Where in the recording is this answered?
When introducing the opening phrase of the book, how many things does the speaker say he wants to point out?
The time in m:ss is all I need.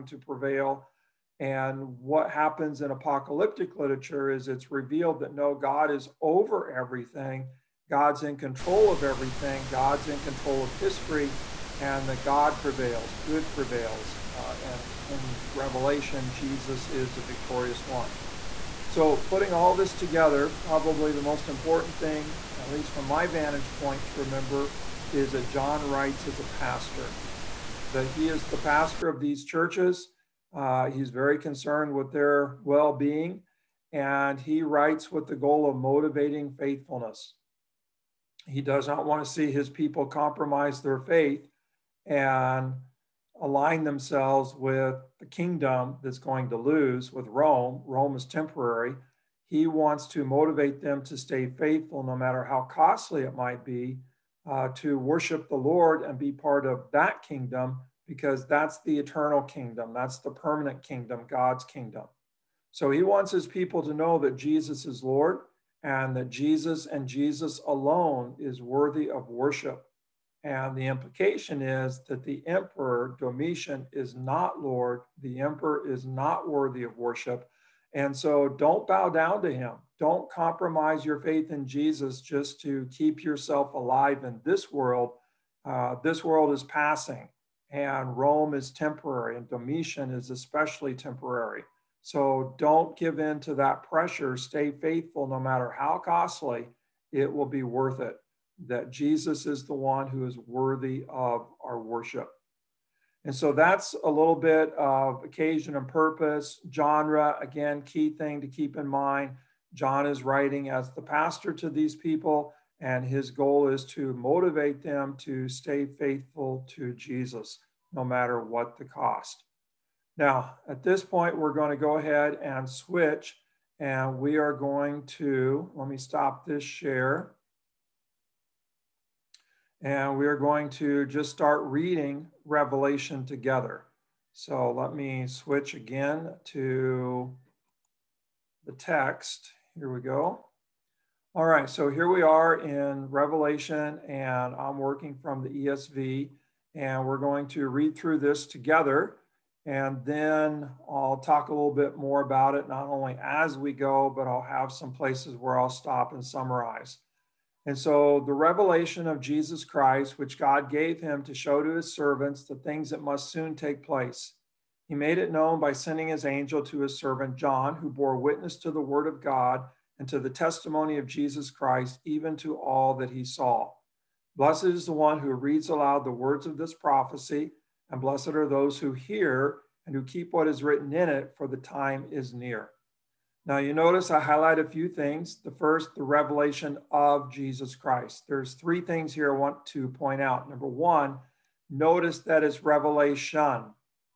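3:08.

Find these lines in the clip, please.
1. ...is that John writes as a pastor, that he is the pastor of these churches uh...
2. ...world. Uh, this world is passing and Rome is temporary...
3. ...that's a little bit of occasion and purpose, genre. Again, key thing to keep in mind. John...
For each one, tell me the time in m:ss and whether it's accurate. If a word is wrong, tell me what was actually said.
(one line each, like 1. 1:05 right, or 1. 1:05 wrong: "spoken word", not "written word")
1. 0:25 right
2. 1:24 right
3. 1:43 right.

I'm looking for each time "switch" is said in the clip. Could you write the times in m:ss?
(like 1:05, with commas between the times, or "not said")
2:02, 2:15.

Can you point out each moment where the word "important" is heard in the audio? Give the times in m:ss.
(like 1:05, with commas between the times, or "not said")
0:21.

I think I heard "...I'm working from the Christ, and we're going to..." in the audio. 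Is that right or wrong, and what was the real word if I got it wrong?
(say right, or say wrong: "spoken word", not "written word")
wrong: "ESV", not "Christ".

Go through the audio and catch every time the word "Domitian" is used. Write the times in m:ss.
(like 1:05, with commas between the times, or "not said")
1:13, 1:29.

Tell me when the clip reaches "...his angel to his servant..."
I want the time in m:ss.
2:46.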